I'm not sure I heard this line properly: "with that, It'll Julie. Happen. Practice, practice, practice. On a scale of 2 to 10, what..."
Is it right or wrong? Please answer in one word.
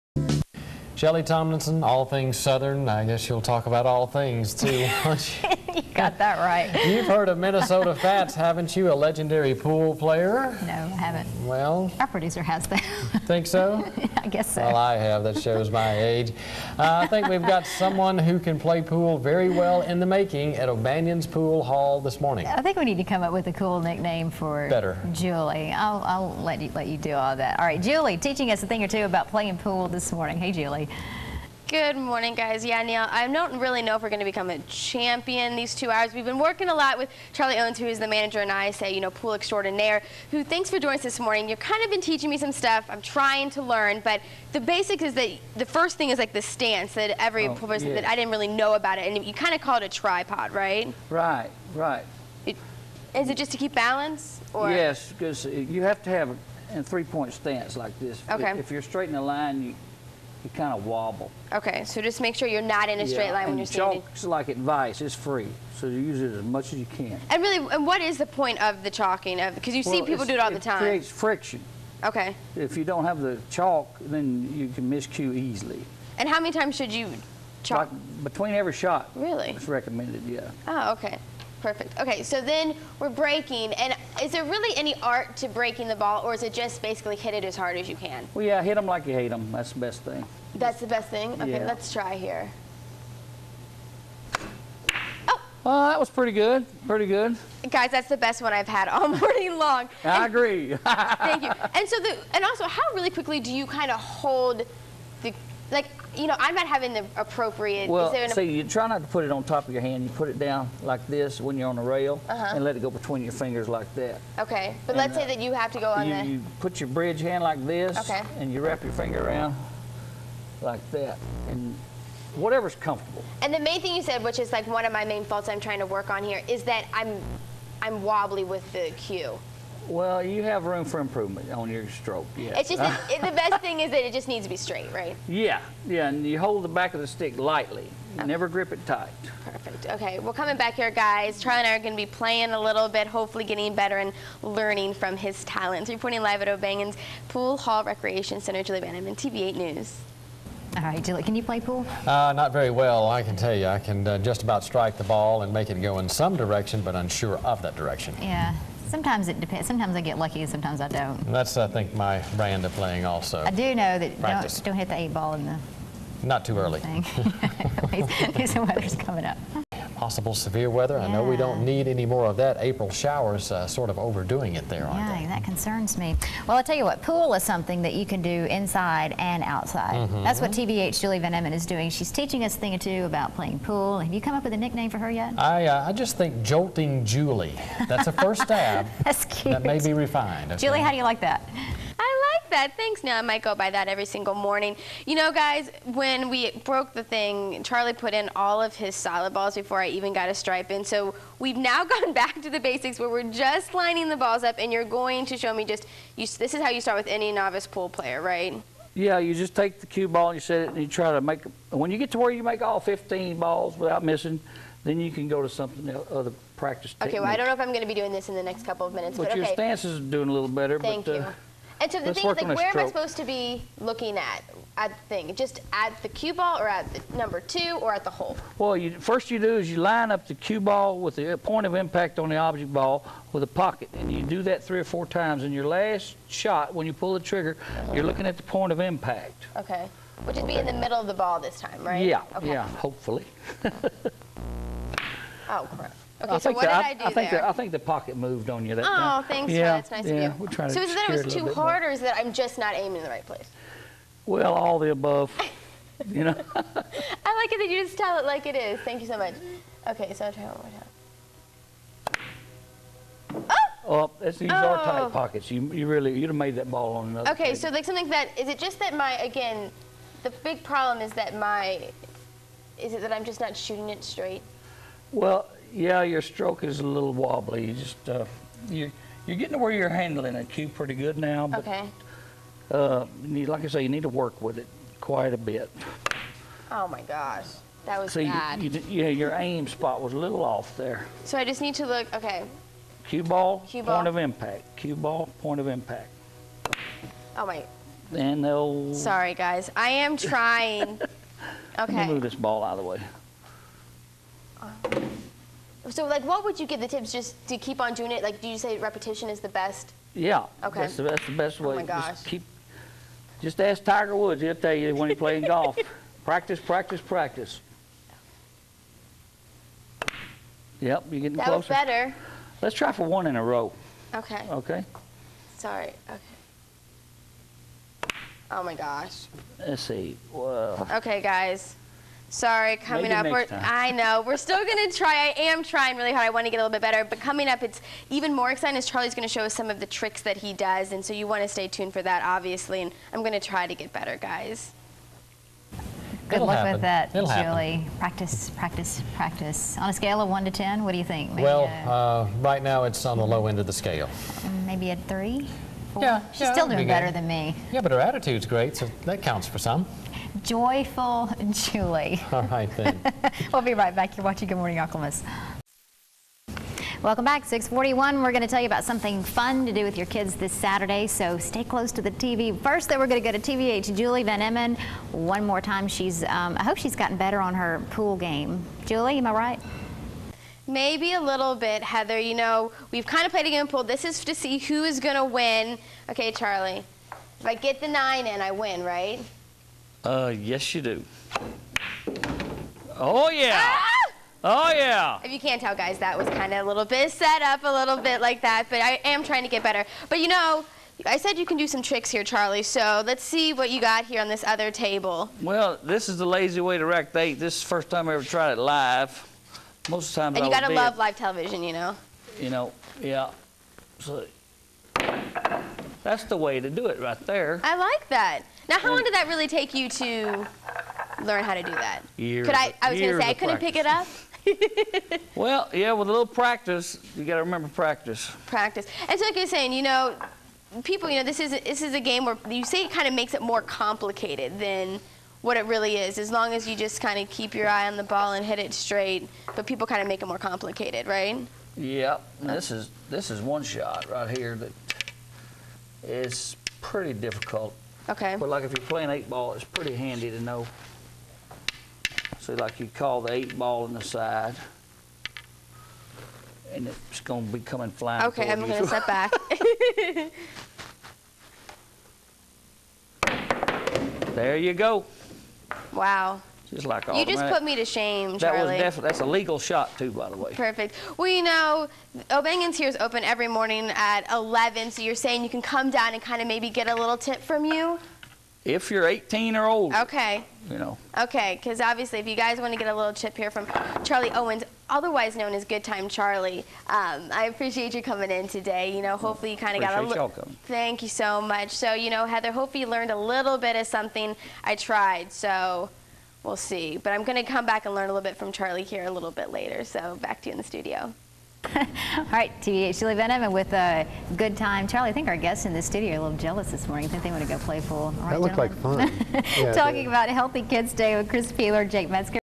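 wrong.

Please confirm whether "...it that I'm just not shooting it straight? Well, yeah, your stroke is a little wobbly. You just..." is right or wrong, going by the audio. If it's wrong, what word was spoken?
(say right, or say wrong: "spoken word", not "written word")
right.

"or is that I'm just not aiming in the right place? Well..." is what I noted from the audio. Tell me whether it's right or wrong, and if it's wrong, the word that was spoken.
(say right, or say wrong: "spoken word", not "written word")
right.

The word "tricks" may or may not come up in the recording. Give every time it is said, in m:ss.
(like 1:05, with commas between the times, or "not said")
5:39, 6:41.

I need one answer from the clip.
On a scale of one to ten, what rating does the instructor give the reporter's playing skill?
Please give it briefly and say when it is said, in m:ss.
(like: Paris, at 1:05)
3, at 5:54.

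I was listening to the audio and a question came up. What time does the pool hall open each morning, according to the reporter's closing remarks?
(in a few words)
11.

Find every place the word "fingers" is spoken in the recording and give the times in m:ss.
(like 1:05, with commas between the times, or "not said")
1:53, 1:58.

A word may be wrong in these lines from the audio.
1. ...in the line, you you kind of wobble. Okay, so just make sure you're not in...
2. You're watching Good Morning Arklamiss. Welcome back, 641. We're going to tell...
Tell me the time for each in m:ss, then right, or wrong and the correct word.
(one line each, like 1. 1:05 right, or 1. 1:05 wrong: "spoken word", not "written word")
1. 0:59 right
2. 6:04 right.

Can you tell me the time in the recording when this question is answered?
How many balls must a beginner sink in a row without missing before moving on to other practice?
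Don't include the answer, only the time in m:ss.
3:32.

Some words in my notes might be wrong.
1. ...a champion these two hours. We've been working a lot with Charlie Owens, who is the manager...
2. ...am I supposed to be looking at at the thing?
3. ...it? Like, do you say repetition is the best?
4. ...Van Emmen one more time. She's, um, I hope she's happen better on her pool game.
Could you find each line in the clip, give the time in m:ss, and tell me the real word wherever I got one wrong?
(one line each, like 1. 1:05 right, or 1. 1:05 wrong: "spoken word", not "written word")
1. 0:34 right
2. 3:42 right
3. 5:08 right
4. 6:14 wrong: "gotten", not "happen".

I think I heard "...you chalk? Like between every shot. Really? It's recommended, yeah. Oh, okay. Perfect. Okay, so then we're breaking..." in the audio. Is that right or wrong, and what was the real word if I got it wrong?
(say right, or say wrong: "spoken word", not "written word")
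right.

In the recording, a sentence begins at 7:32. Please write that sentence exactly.
So like you call the eight ball on the side, and it's going to be coming flying.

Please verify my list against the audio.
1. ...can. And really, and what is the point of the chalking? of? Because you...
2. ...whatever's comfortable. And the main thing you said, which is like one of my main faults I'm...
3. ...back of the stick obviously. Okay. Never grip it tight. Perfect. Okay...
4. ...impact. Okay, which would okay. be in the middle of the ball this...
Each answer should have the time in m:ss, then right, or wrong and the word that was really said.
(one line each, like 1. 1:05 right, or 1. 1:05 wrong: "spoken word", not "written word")
1. 1:06 right
2. 2:02 right
3. 2:16 wrong: "lightly", not "obviously"
4. 3:58 right.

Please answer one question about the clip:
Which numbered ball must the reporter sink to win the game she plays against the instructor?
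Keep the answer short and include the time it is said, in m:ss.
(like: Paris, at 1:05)
nine, at 6:27.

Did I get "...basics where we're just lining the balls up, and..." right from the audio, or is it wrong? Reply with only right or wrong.
right.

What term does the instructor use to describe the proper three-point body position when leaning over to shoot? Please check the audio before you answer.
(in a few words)
tripod.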